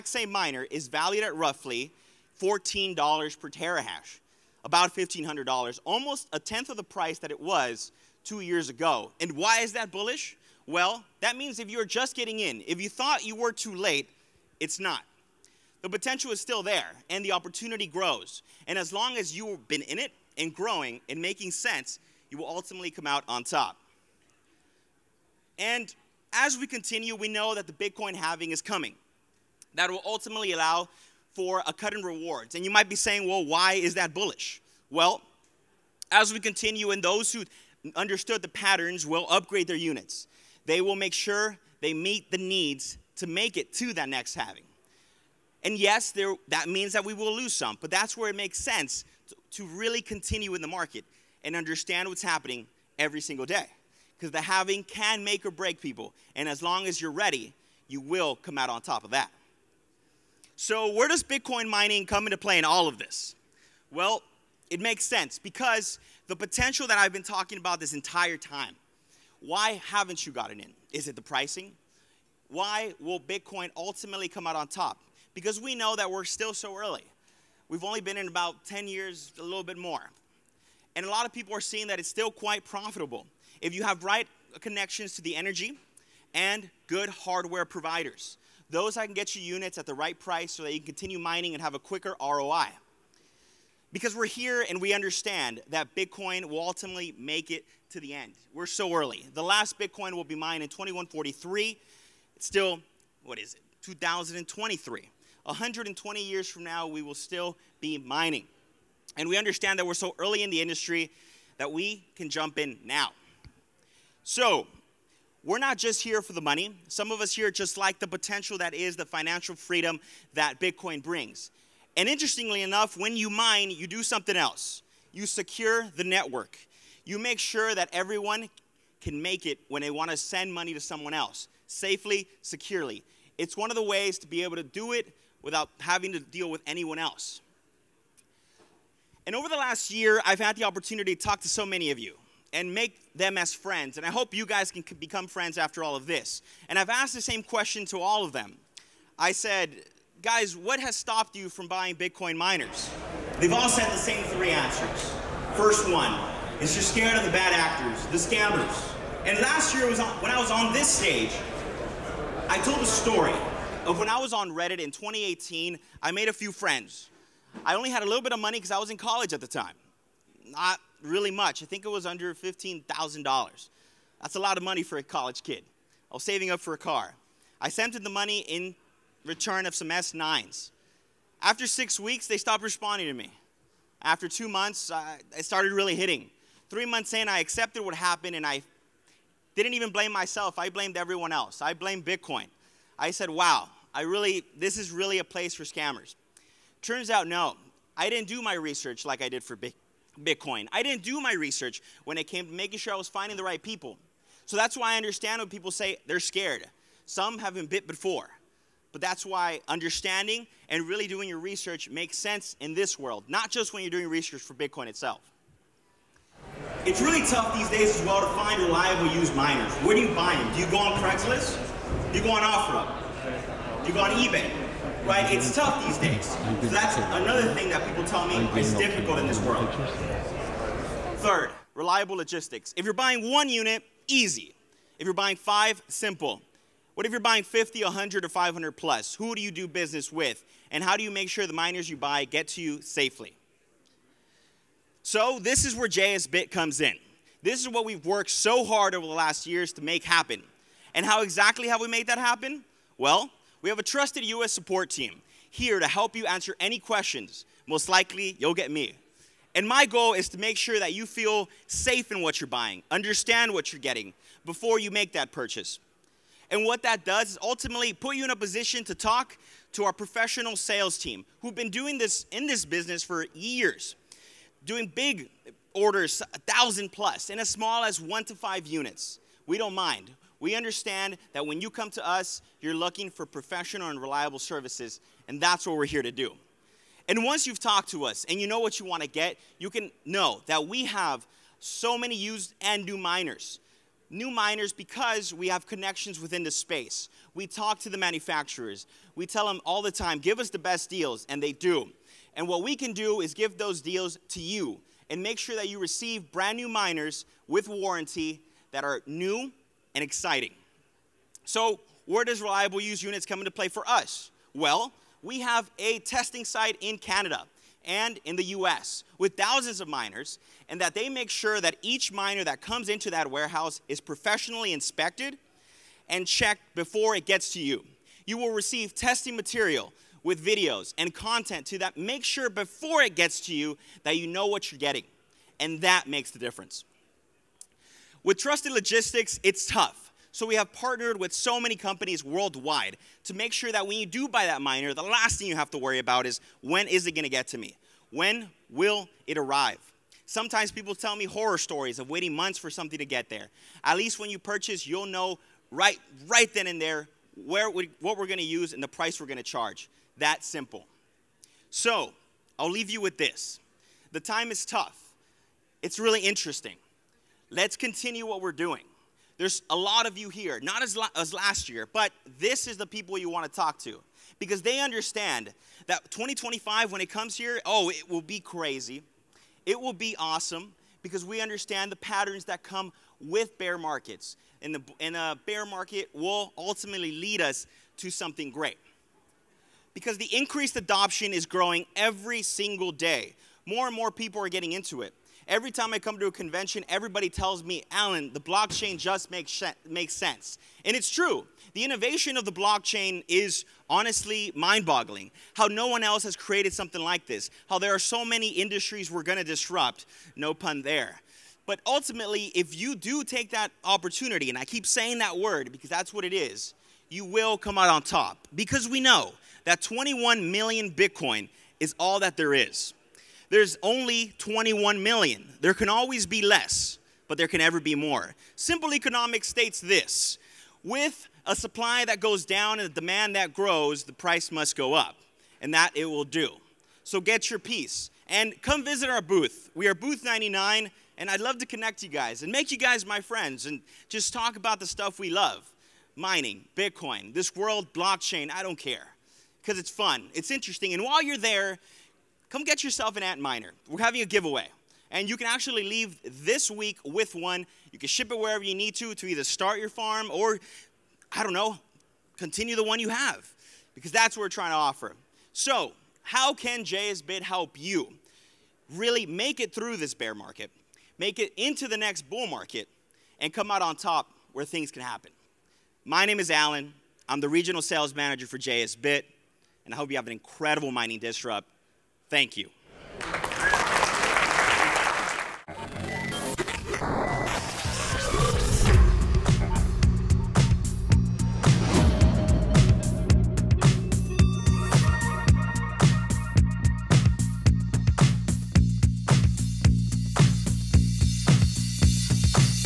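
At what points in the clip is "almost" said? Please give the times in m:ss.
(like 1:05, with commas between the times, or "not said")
0:05.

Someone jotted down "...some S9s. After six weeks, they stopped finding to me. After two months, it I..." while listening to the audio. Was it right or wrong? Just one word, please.
wrong.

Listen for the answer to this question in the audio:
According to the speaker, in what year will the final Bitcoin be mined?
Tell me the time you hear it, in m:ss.
1:40.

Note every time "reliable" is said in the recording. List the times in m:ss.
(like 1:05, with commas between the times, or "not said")
3:38, 3:51, 4:44, 5:12.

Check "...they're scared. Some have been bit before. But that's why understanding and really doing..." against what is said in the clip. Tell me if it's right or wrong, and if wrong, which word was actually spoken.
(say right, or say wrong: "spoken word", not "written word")
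right.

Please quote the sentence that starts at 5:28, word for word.
You will receive testing material with videos and content to that.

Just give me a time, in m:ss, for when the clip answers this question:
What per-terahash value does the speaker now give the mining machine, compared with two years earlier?
0:02.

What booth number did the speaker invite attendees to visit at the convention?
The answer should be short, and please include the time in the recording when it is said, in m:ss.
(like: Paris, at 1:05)
99, at 7:19.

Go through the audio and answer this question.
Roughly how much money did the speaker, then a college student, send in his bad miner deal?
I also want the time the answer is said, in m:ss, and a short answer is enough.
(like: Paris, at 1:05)
under $15,000, at 2:52.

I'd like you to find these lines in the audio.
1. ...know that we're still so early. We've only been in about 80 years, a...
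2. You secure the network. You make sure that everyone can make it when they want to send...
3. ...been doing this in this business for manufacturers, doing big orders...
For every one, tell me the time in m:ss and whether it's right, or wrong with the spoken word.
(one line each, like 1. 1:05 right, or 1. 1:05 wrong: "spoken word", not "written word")
1. 1:15 wrong: "10", not "80"
2. 2:05 right
3. 4:31 wrong: "years", not "manufacturers".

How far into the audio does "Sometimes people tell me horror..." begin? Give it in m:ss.
5:50.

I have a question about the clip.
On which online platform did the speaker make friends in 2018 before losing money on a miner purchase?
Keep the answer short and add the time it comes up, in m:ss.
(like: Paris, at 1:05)
Reddit, at 2:44.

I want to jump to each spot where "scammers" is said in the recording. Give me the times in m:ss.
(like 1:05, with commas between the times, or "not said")
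2:38, 3:15.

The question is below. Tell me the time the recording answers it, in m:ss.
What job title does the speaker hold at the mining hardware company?
7:57.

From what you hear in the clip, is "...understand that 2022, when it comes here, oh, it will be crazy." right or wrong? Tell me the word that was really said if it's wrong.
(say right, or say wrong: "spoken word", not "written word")
wrong: "2025", not "2022".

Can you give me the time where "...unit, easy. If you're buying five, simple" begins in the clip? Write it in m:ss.
3:53.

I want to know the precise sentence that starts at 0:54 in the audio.
Because the halving can make or break people.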